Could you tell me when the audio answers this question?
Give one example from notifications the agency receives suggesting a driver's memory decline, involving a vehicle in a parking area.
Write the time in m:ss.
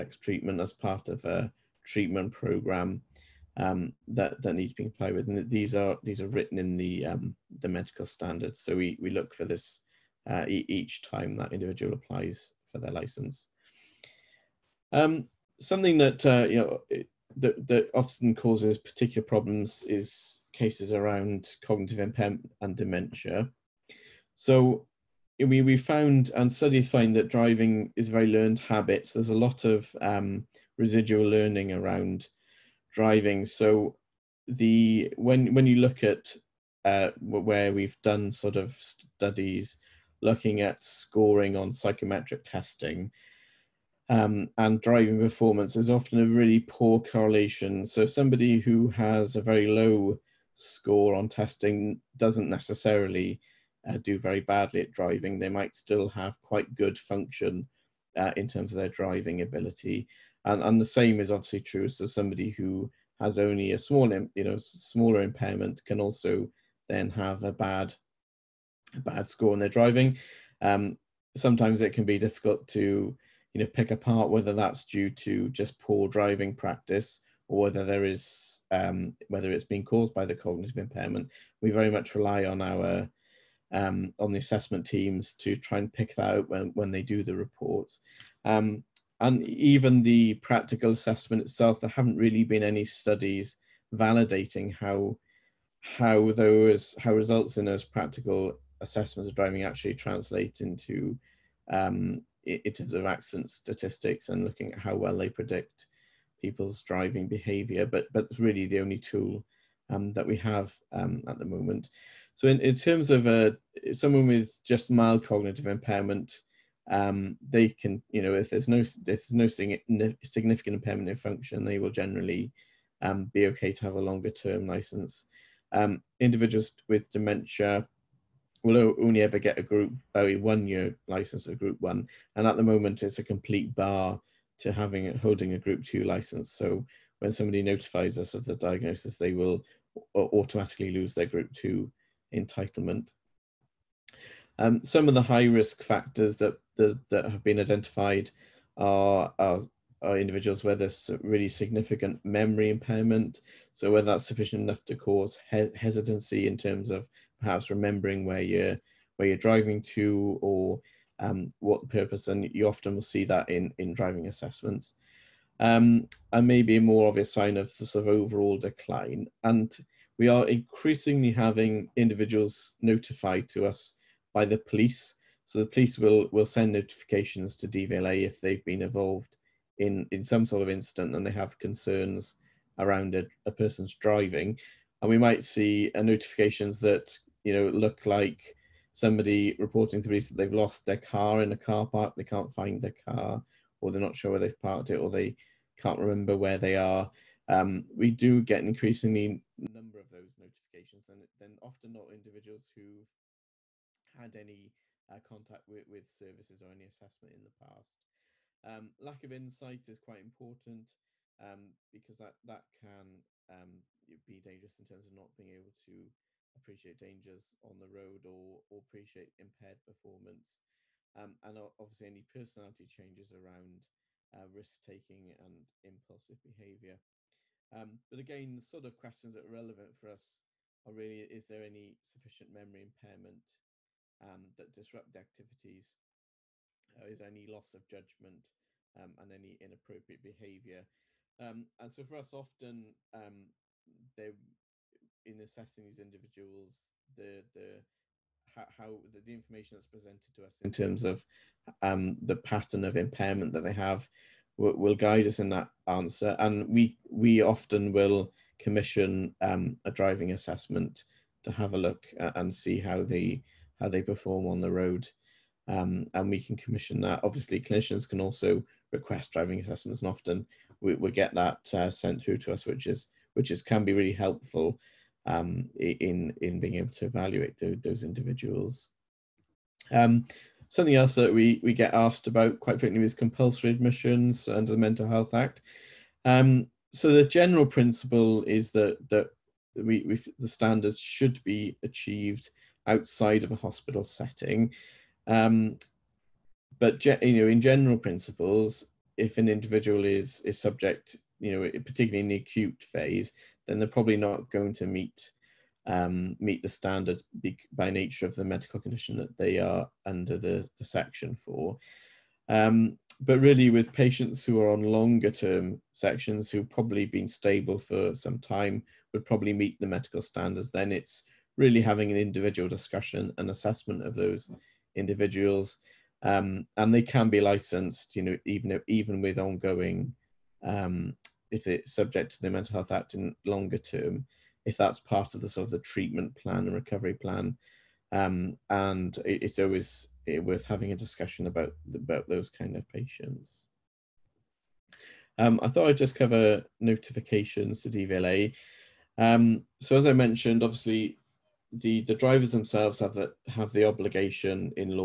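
3:10.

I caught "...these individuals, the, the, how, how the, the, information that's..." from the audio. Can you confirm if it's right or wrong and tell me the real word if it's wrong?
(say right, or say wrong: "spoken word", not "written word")
right.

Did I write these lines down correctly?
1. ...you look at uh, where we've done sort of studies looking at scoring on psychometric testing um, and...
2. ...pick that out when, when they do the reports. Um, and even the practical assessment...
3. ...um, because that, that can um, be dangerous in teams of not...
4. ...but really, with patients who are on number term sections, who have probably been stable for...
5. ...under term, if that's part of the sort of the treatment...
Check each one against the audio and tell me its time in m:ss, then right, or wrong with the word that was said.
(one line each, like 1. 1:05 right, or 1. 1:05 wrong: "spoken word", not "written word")
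1. 0:35 right
2. 1:25 right
3. 3:31 wrong: "terms", not "teams"
4. 5:13 wrong: "longer", not "number"
5. 5:33 wrong: "longer", not "under".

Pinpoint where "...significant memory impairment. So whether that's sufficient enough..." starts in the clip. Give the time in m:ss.
2:31.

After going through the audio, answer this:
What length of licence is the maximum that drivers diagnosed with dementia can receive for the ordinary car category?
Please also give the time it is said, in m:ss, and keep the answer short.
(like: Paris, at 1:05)
One year, at 2:10.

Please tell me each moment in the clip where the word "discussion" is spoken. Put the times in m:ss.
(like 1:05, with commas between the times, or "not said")
5:22, 5:40.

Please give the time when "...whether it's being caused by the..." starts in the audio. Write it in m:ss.
1:19.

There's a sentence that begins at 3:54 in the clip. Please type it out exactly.
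um, that disrupt the activities uh, is any loss of judgment um, and any inappropriate behavior.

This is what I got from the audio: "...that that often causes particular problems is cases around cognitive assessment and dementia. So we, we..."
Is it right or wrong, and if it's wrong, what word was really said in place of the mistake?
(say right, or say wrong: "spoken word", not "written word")
wrong: "impairment", not "assessment".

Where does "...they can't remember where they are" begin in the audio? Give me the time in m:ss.
3:15.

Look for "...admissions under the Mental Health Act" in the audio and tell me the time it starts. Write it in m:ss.
4:43.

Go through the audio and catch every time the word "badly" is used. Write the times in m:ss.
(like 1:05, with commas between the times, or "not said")
0:54.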